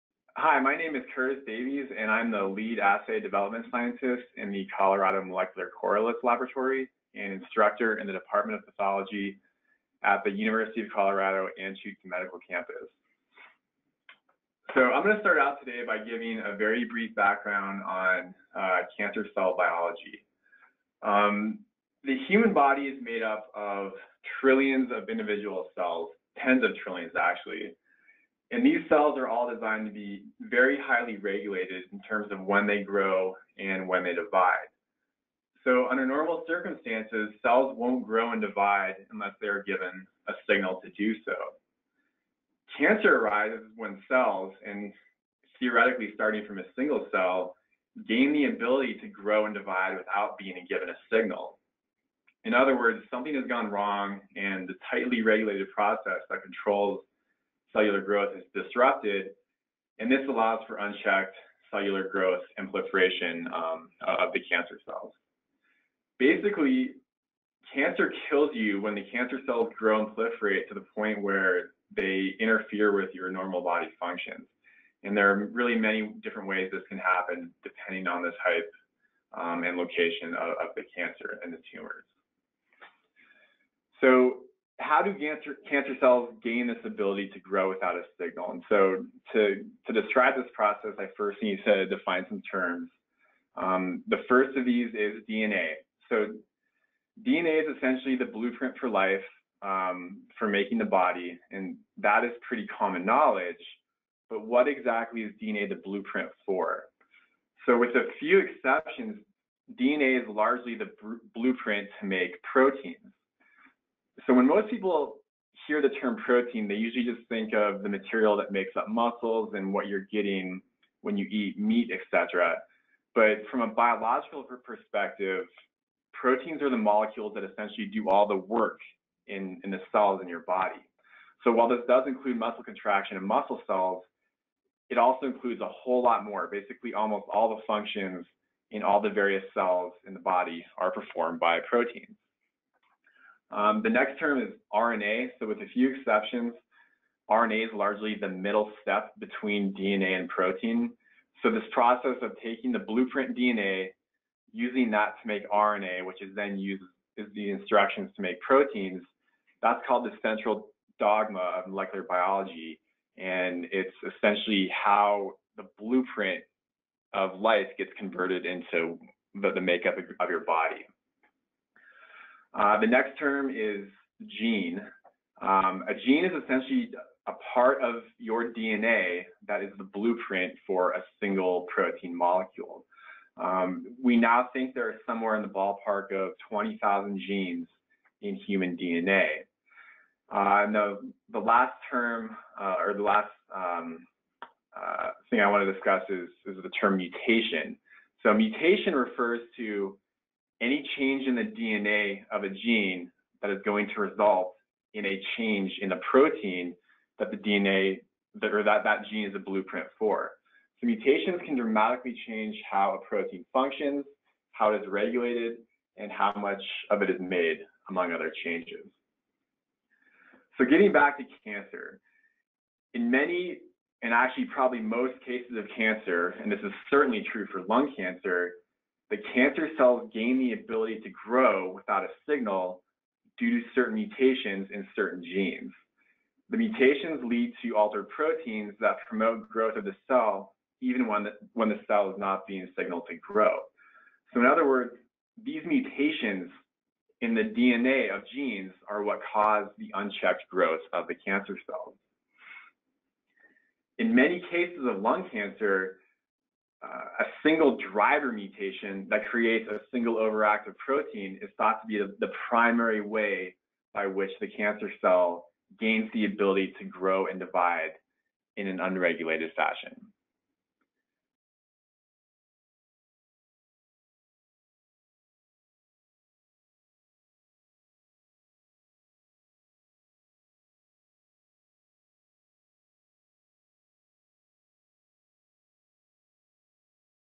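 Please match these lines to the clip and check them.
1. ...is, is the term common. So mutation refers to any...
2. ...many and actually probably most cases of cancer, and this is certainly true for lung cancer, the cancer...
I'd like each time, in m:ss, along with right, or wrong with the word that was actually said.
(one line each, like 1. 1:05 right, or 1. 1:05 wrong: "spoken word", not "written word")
1. 3:16 wrong: "mutation", not "common"
2. 3:43 right.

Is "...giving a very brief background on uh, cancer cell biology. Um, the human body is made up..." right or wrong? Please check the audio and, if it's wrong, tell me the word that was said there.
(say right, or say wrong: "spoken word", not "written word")
right.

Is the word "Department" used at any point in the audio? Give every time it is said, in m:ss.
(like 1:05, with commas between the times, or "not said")
0:08.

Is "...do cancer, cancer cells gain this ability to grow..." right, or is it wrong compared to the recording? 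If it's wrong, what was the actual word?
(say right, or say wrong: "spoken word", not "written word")
right.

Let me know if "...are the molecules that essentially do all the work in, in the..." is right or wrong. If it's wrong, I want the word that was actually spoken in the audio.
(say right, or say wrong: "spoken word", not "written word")
right.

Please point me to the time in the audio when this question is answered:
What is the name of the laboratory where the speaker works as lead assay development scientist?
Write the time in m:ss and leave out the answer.
0:04.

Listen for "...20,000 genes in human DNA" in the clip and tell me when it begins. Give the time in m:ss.
3:06.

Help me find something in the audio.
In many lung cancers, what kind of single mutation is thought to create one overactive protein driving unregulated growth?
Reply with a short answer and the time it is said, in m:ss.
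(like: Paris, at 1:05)
driver mutation, at 4:17.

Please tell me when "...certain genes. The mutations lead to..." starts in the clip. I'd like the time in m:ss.
3:54.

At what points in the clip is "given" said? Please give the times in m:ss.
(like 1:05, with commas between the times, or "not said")
0:39, 0:50.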